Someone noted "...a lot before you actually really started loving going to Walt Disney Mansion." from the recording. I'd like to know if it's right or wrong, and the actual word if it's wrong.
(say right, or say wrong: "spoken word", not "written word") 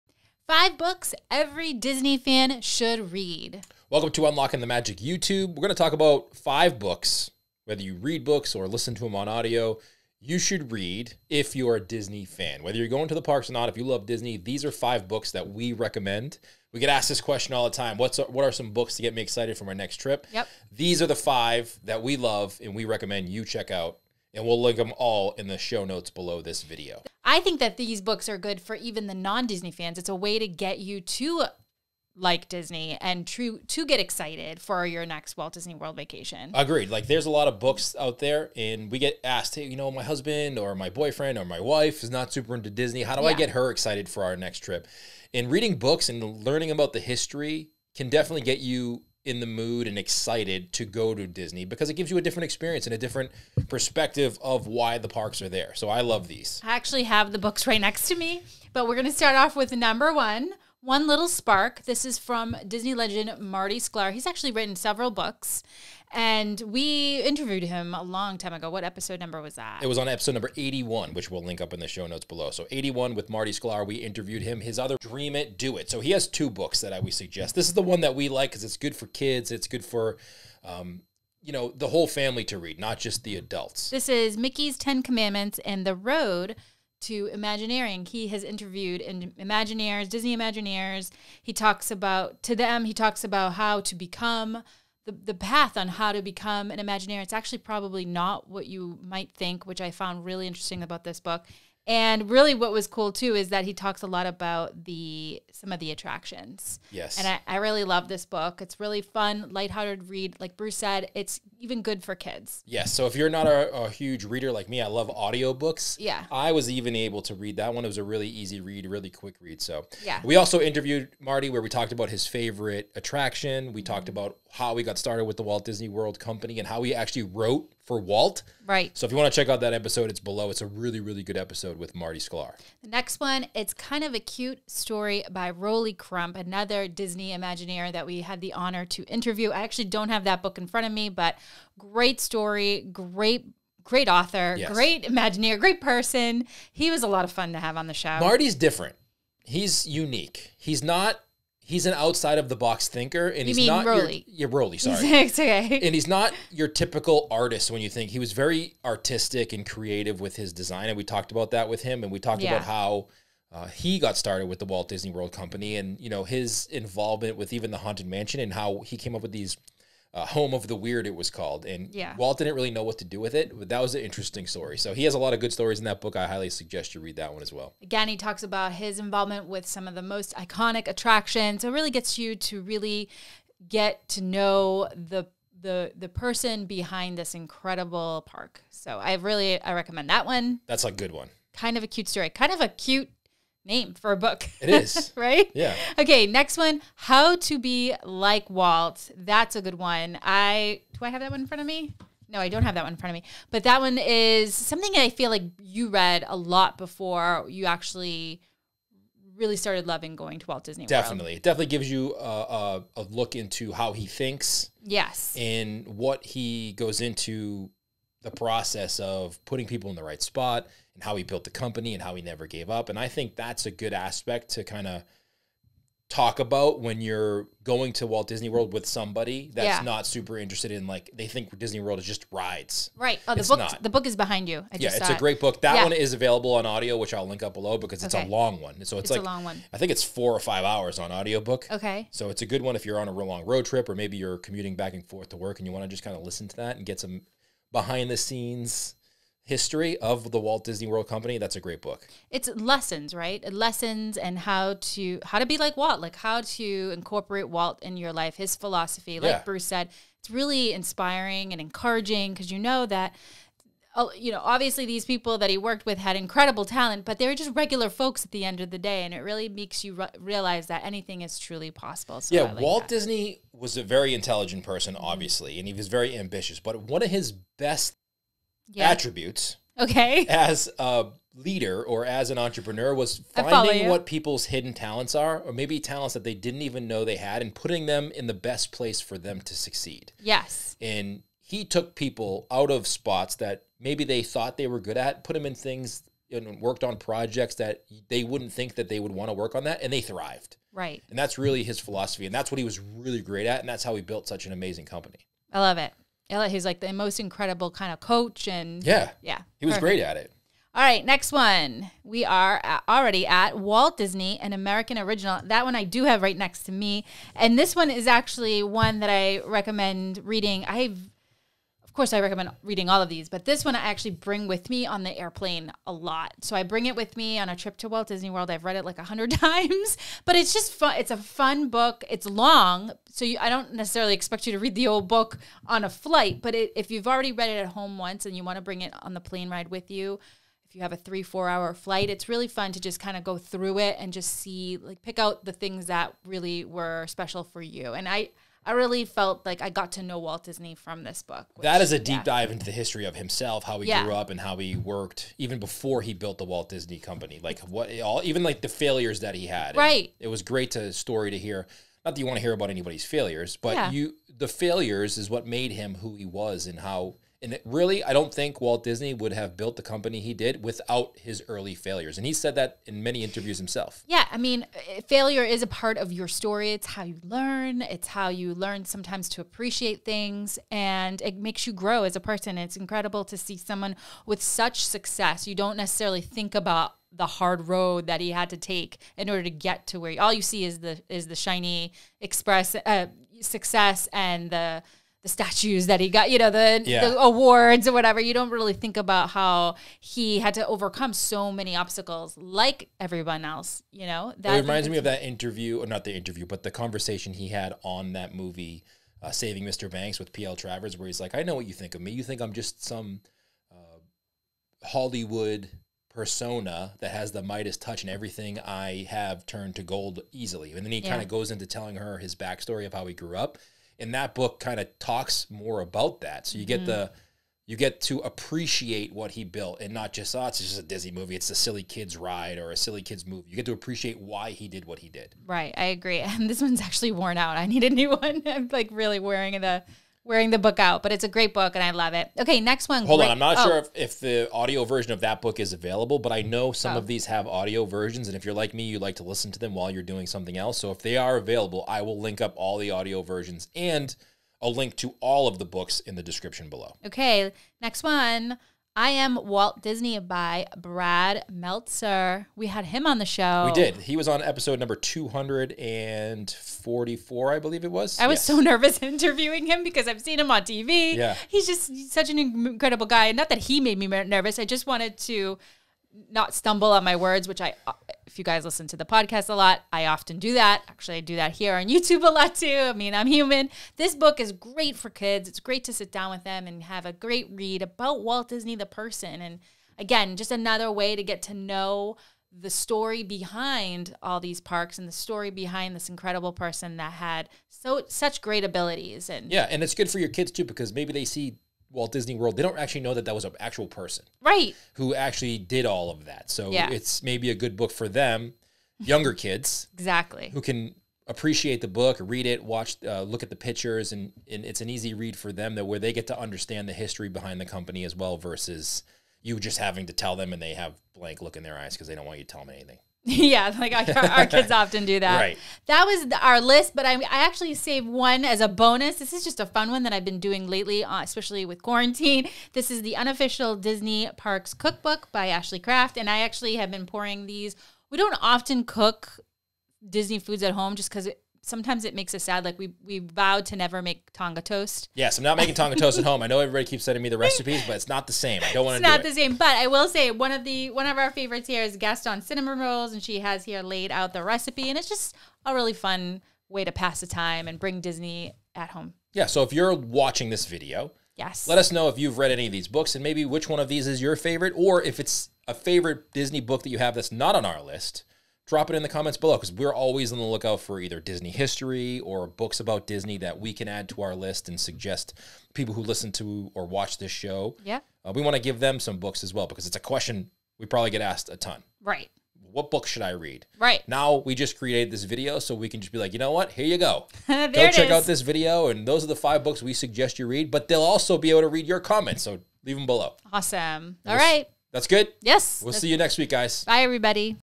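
wrong: "Definitely", not "Mansion".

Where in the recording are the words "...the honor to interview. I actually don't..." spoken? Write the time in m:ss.
2:18.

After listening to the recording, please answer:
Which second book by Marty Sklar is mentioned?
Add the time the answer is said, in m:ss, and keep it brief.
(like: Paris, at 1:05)
Dream It, Do It, at 1:14.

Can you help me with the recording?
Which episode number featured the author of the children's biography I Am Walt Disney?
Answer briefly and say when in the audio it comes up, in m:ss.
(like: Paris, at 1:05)
244, at 7:44.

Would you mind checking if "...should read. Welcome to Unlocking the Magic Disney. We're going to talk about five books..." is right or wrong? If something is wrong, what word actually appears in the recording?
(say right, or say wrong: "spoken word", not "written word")
wrong: "YouTube", not "Disney".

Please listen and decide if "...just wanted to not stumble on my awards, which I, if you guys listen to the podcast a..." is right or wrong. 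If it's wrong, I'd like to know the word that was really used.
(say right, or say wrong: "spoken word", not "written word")
wrong: "words", not "awards".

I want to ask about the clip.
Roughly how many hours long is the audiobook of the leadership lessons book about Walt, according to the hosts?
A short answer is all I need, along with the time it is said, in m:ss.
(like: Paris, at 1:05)
4 or 5 hours, at 4:00.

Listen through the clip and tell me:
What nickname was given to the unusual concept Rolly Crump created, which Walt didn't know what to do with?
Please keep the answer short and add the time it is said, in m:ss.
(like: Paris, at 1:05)
Home of the Weird, at 2:50.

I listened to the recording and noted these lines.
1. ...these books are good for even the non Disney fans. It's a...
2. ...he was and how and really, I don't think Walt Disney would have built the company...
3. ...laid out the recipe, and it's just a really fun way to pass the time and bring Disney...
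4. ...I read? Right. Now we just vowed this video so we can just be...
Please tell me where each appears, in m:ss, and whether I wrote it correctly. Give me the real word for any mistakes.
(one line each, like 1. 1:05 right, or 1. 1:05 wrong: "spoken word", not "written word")
1. 0:27 right
2. 6:06 right
3. 9:13 right
4. 9:43 wrong: "created", not "vowed".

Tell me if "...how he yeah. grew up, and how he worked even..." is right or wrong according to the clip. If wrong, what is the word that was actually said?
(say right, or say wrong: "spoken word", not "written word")
right.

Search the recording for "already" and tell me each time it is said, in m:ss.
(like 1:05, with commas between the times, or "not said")
5:12, 5:37.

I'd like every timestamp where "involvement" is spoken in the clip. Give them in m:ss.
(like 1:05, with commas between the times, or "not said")
2:46, 2:58.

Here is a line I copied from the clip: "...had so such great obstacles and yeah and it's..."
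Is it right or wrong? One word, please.
wrong.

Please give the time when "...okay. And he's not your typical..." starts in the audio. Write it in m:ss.
2:35.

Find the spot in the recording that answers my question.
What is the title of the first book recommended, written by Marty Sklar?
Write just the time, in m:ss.
1:00.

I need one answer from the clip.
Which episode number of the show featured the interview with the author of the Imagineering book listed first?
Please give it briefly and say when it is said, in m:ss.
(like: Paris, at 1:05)
81, at 1:10.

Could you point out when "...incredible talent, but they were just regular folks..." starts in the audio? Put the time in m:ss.
4:26.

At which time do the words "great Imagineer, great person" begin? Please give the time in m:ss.
2:24.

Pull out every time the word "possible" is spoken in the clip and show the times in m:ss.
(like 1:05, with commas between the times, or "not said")
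4:31.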